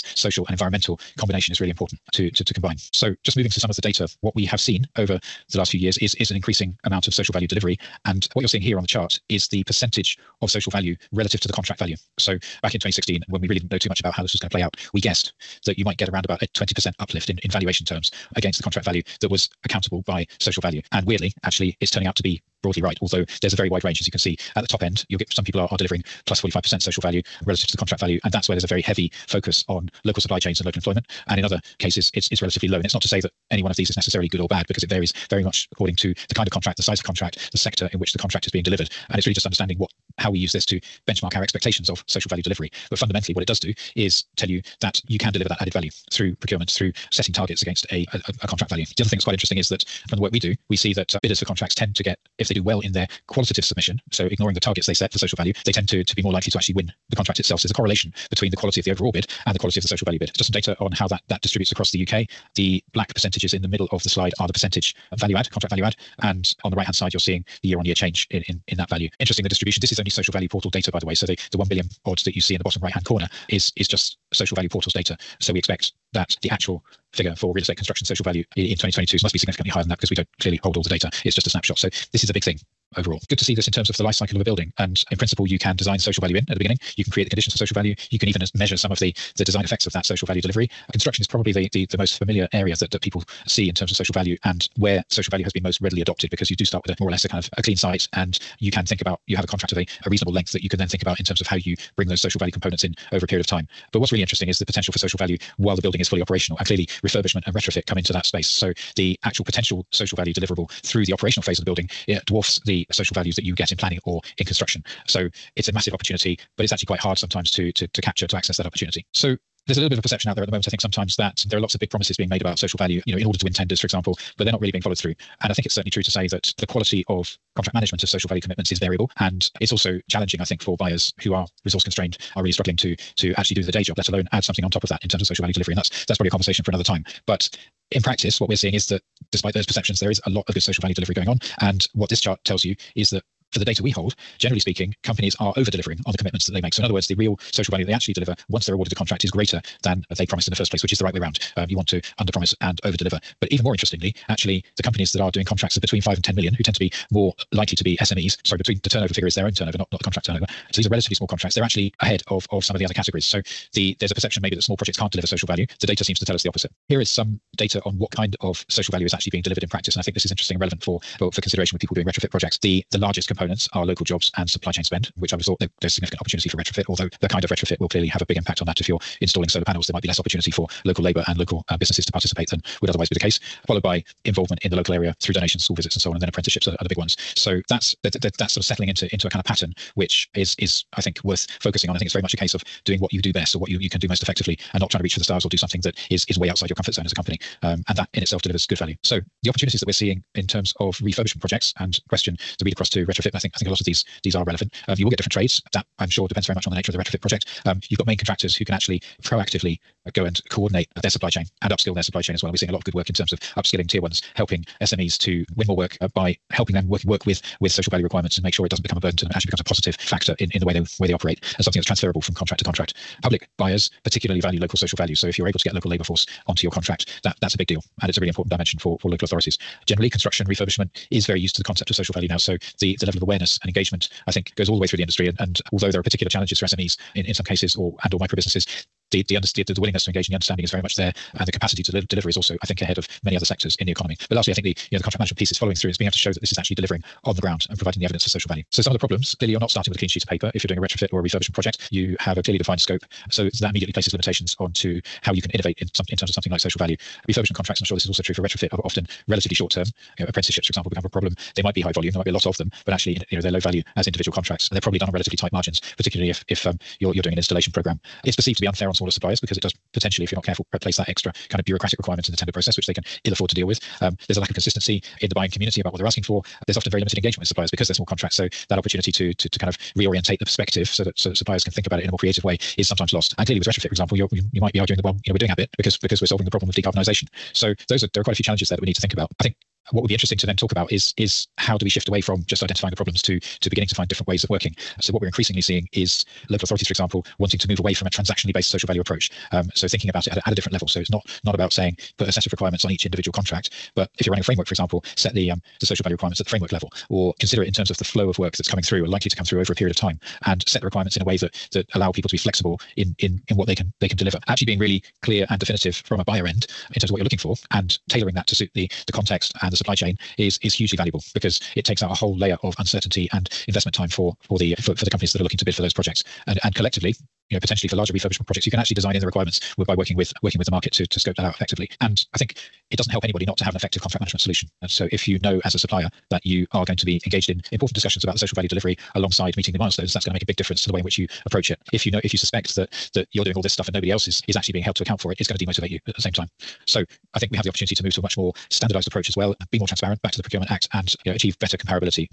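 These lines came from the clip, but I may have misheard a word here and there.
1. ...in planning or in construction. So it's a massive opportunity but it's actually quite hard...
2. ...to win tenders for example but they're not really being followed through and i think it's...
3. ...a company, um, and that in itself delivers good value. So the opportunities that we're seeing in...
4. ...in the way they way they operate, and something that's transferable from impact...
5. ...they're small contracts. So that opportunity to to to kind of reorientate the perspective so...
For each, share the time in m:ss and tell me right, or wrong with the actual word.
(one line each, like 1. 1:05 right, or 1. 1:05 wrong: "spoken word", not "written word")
1. 1:53 right
2. 2:03 right
3. 3:17 right
4. 3:40 wrong: "contract", not "impact"
5. 4:37 right.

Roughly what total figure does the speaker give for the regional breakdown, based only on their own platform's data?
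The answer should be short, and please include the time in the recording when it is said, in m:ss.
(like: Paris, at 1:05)
1 billion, at 1:11.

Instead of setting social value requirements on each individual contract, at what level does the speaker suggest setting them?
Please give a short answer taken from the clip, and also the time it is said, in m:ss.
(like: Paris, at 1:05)
Framework level, at 5:06.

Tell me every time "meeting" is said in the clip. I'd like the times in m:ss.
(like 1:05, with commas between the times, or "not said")
5:39.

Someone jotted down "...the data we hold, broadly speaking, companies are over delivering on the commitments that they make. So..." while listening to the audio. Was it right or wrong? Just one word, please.
wrong.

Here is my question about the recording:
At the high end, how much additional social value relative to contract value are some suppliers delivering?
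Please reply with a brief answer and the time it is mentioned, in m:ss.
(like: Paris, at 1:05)
45%, at 0:26.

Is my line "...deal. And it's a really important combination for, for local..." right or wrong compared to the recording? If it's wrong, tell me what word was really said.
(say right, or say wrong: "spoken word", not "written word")
wrong: "dimension", not "combination".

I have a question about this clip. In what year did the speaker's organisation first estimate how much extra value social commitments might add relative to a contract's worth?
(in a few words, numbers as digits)
2016.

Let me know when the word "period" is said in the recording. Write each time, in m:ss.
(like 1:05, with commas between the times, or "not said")
1:43, 5:09.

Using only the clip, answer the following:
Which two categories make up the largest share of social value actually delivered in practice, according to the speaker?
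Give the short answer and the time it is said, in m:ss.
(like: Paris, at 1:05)
Local jobs and supply chain spend, at 2:53.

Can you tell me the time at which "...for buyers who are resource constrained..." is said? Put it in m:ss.
2:10.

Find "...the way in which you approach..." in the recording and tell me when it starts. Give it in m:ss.
5:40.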